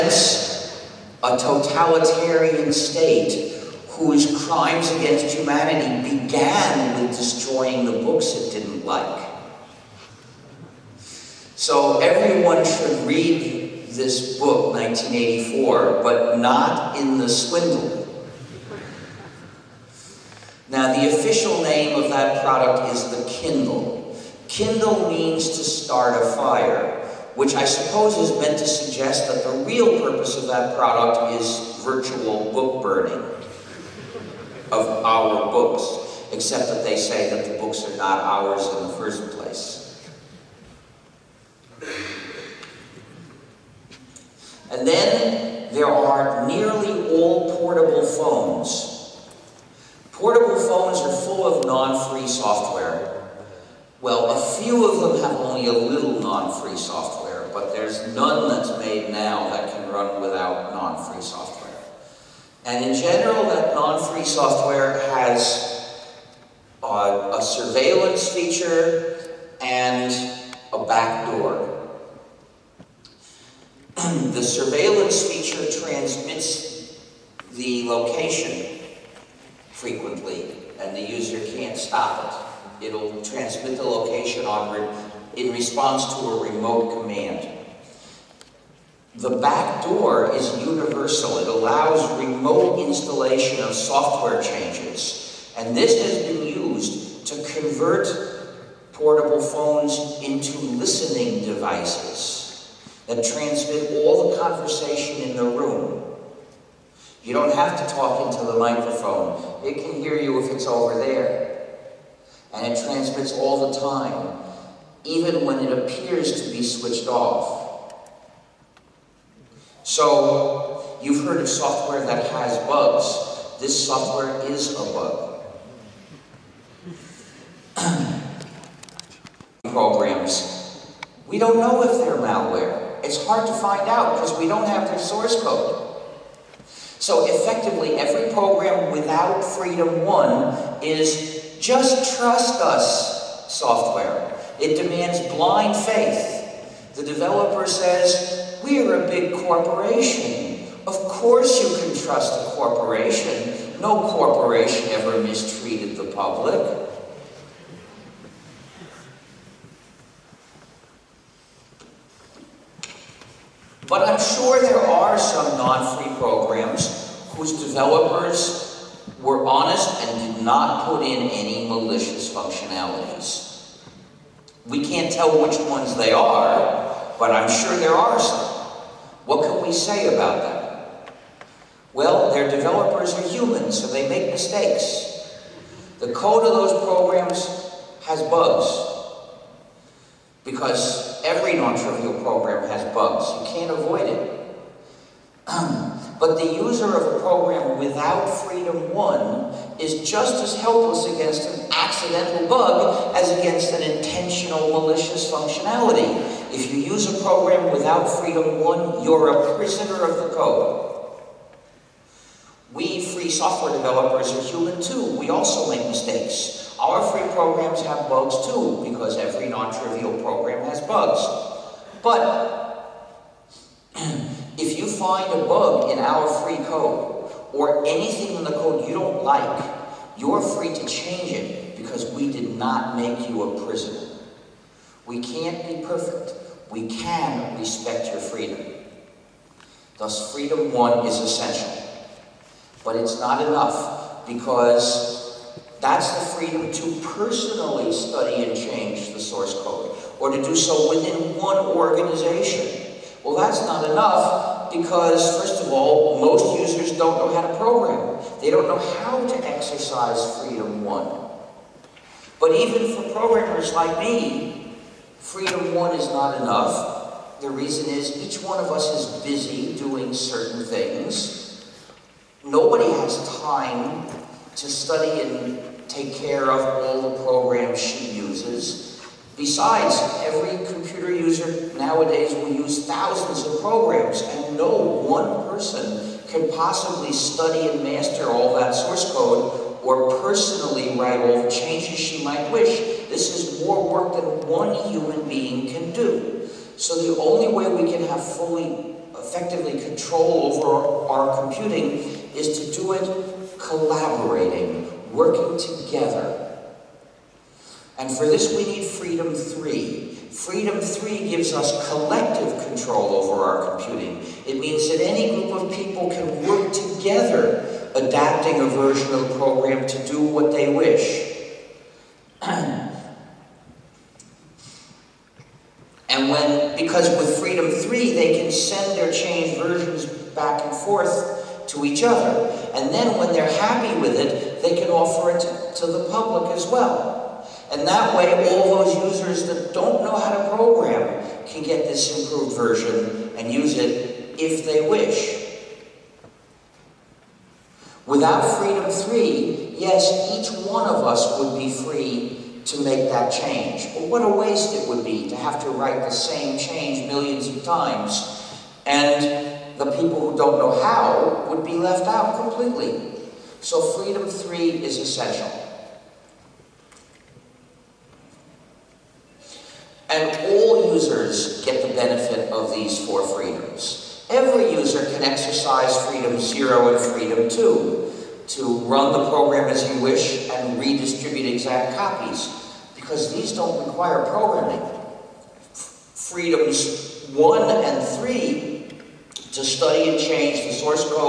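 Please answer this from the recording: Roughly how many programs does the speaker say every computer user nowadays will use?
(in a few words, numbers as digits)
thousands.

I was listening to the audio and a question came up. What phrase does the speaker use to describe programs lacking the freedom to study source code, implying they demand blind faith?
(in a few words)
trust us software.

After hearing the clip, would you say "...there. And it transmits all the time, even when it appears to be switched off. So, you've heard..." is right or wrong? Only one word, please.
right.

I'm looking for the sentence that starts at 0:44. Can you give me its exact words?
And then there are nearly all portable phones.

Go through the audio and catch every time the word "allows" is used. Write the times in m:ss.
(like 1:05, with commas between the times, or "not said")
1:31.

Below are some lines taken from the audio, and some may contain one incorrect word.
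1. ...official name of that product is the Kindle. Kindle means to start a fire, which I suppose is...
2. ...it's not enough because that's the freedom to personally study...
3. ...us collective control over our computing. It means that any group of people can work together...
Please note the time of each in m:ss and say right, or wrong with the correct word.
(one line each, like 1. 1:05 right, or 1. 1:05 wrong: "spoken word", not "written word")
1. 0:21 right
2. 4:02 right
3. 5:11 right.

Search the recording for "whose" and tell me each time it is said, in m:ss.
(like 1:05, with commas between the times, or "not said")
0:03, 2:47.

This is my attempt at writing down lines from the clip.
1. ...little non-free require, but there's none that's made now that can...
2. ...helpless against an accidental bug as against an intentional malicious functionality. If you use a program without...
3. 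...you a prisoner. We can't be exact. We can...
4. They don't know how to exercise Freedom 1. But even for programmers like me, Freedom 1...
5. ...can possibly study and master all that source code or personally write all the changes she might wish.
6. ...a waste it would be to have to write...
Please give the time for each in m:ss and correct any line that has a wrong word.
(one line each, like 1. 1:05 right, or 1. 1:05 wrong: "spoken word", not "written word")
1. 0:55 wrong: "software", not "require"
2. 3:20 right
3. 3:53 wrong: "perfect", not "exact"
4. 4:18 right
5. 4:46 right
6. 5:54 right.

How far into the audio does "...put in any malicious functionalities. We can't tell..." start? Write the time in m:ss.
2:50.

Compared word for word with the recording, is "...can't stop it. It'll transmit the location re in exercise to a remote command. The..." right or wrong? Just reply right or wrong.
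wrong.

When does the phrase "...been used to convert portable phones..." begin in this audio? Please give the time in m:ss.
1:36.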